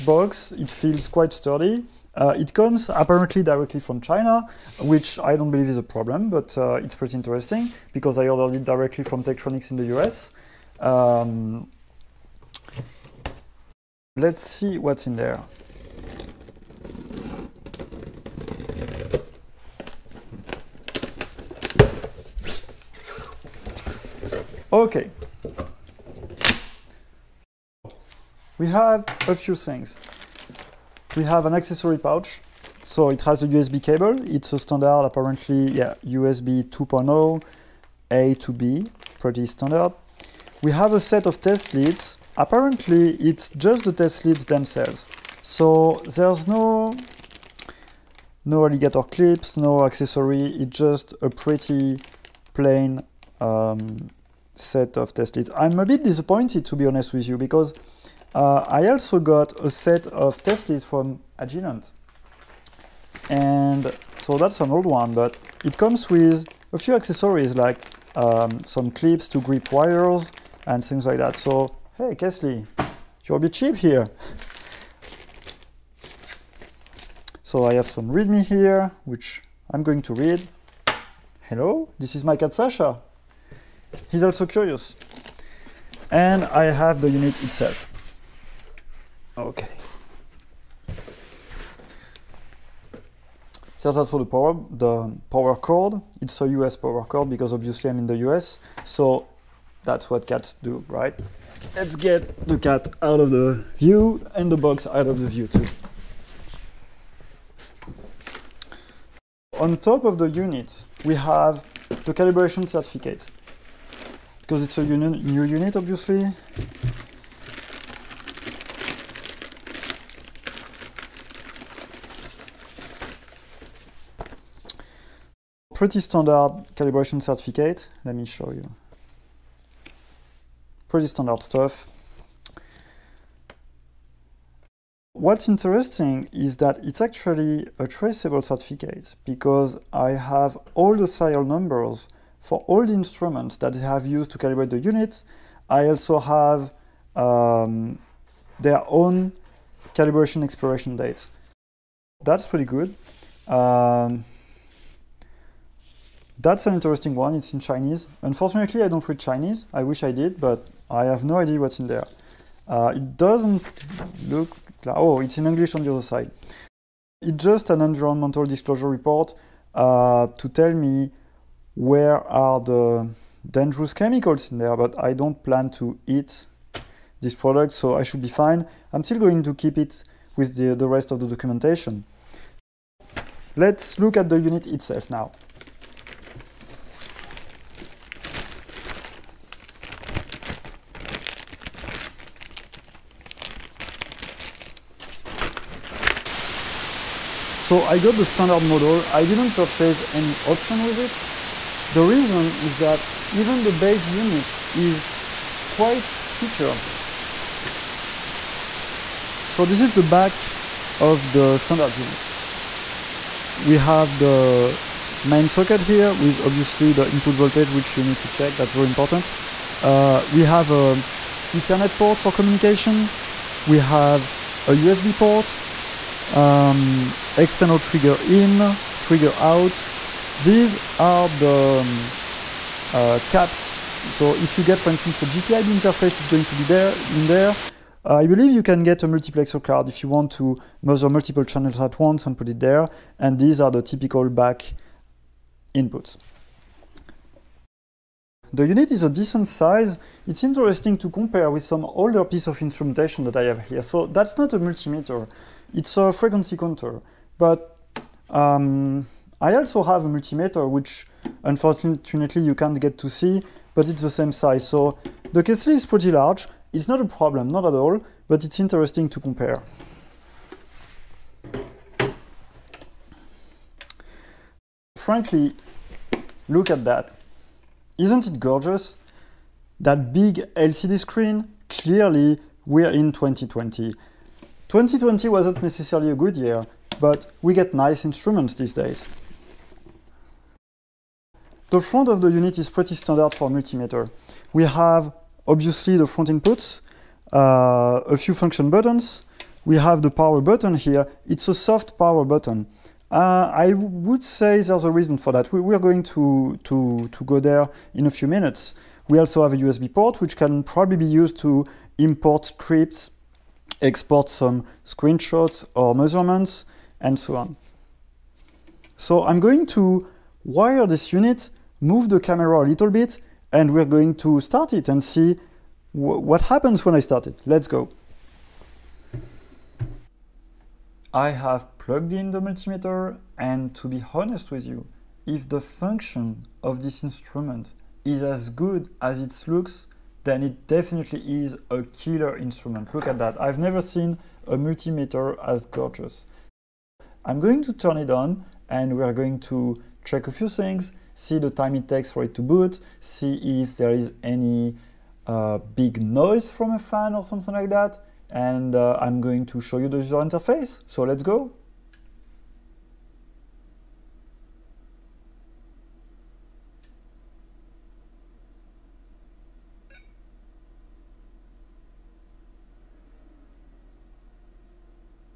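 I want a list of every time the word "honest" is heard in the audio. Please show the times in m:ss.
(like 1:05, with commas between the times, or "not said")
0:56, 5:34.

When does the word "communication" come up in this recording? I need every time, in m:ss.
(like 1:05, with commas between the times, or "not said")
3:42.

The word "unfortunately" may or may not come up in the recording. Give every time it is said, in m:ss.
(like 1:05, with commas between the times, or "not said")
2:38, 4:21.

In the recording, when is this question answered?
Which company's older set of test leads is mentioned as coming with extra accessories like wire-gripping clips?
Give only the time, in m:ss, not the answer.
1:01.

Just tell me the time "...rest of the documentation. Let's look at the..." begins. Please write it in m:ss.
3:00.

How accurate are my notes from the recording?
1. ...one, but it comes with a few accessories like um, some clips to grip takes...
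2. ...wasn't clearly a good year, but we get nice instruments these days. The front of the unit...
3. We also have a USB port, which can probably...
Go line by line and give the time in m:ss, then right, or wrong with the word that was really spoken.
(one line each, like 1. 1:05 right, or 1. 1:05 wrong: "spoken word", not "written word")
1. 1:04 wrong: "wires", not "takes"
2. 4:45 wrong: "necessarily", not "clearly"
3. 5:09 right.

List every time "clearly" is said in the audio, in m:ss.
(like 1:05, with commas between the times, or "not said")
4:41.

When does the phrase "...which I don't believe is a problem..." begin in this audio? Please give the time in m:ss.
0:04.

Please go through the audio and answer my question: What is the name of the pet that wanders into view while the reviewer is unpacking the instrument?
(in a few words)
Sasha.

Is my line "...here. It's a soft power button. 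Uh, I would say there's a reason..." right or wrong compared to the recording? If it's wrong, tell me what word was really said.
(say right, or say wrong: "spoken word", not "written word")
right.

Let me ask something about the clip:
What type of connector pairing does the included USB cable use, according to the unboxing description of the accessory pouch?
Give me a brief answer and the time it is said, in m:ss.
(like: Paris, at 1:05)
A to B, at 0:38.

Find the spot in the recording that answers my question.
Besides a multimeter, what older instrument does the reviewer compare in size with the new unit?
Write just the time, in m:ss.
4:16.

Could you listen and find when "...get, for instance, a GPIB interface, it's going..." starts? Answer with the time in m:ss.
3:54.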